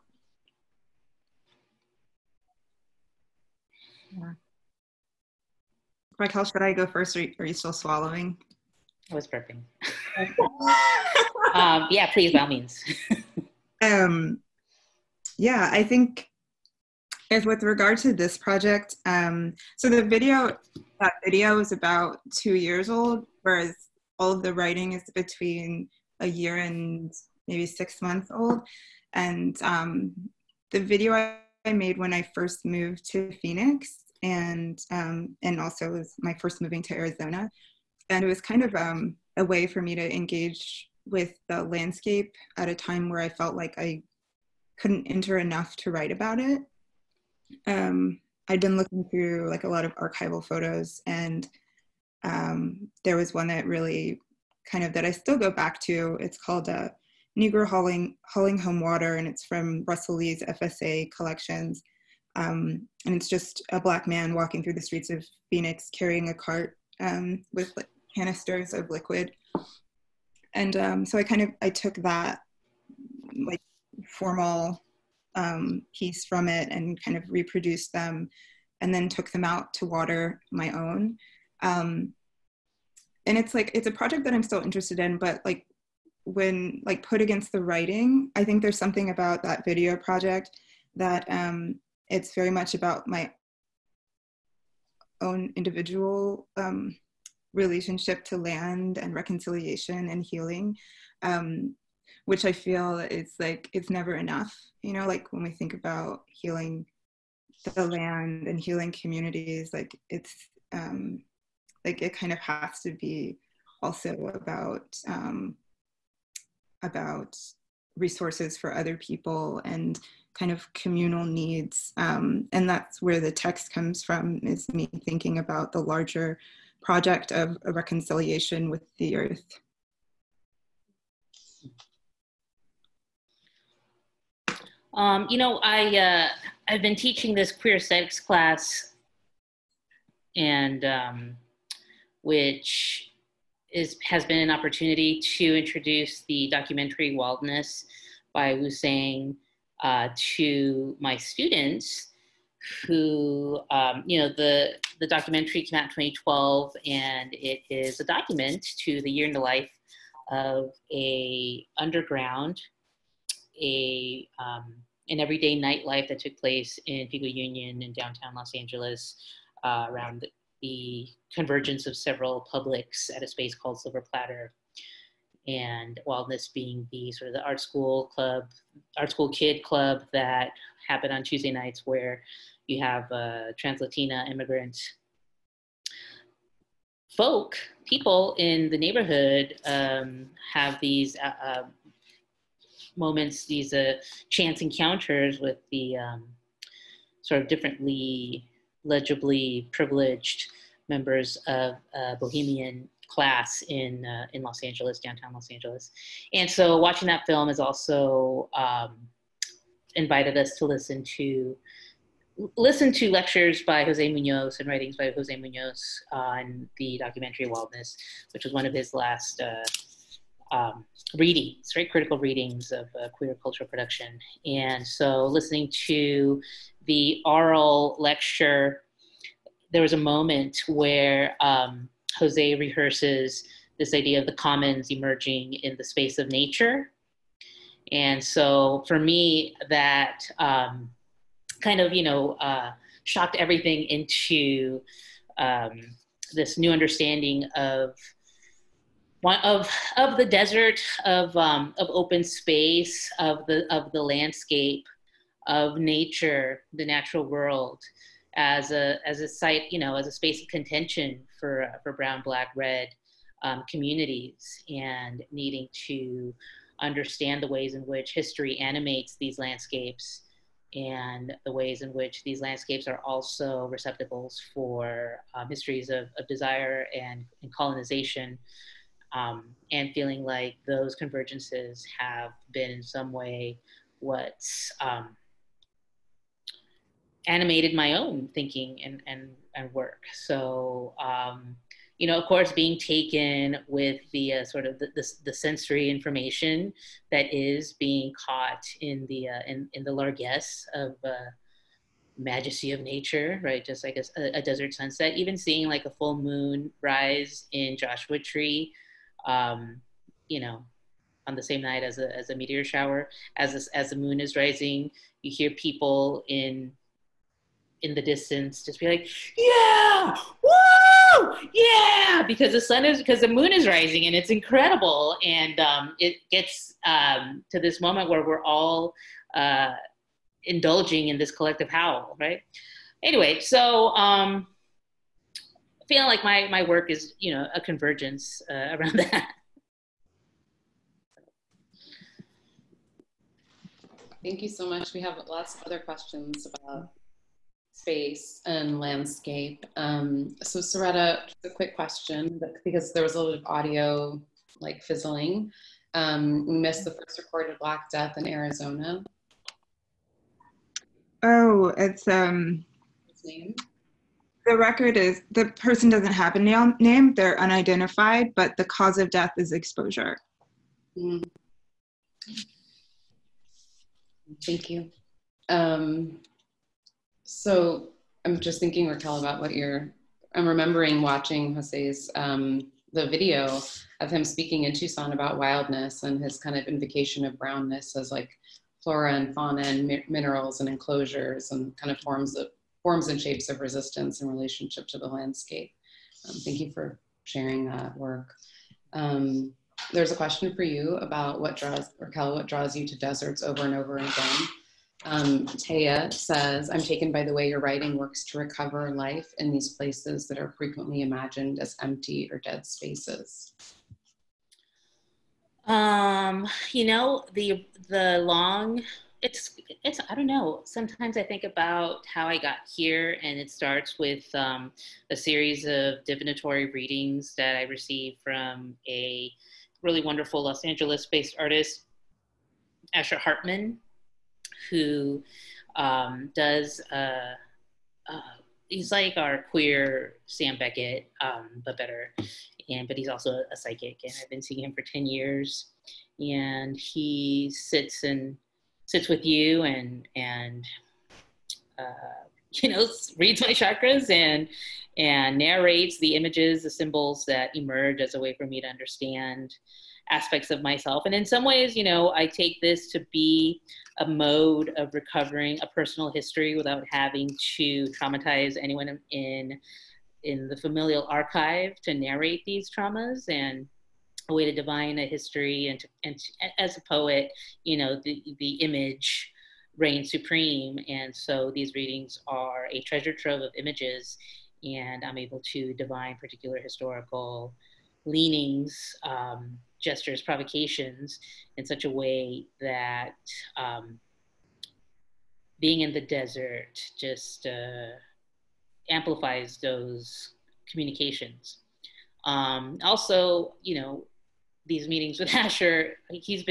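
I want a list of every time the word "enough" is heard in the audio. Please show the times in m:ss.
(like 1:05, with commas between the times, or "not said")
0:45, 1:44.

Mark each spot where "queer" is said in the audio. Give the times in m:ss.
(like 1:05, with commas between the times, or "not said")
2:17, 3:43, 7:19.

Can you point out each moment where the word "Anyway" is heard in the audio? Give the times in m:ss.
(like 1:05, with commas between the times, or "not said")
5:33.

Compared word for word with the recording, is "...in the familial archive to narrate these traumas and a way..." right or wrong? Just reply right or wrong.
right.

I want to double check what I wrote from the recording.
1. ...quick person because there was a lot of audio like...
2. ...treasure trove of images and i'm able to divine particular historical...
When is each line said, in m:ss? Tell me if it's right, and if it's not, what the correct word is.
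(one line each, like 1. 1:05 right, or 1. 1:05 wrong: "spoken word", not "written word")
1. 5:51 wrong: "question", not "person"
2. 8:02 right.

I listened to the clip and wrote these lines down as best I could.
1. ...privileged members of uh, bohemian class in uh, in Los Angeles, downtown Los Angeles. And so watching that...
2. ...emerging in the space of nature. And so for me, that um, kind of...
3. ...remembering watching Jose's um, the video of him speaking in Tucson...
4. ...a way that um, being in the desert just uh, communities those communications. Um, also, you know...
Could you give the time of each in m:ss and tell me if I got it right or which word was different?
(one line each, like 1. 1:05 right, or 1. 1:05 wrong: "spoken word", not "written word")
1. 3:19 right
2. 3:54 right
3. 6:20 right
4. 8:11 wrong: "amplifies", not "communities".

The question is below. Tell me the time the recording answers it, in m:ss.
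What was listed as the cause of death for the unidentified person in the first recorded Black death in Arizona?
6:09.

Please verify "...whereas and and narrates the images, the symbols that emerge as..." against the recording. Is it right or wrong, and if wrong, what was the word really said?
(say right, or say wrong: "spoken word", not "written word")
wrong: "chakras", not "whereas".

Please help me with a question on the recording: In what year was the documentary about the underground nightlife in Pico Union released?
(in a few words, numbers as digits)
2012.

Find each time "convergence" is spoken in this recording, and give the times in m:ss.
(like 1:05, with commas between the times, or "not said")
2:51, 4:40, 5:37.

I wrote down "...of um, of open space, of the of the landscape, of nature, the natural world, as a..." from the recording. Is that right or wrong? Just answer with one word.
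right.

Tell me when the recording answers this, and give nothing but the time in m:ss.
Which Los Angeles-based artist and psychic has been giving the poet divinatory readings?
7:12.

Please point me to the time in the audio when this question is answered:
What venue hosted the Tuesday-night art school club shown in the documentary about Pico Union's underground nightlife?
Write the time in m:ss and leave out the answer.
2:53.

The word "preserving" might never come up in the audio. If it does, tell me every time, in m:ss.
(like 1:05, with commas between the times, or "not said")
not said.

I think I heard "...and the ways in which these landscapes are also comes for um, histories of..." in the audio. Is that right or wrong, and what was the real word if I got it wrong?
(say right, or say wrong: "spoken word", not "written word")
wrong: "receptacles", not "comes".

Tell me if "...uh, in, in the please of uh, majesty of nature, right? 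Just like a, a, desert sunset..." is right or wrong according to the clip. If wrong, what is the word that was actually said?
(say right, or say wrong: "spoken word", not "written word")
wrong: "largesse", not "please".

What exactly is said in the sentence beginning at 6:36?
Um, thank you for sharing that work.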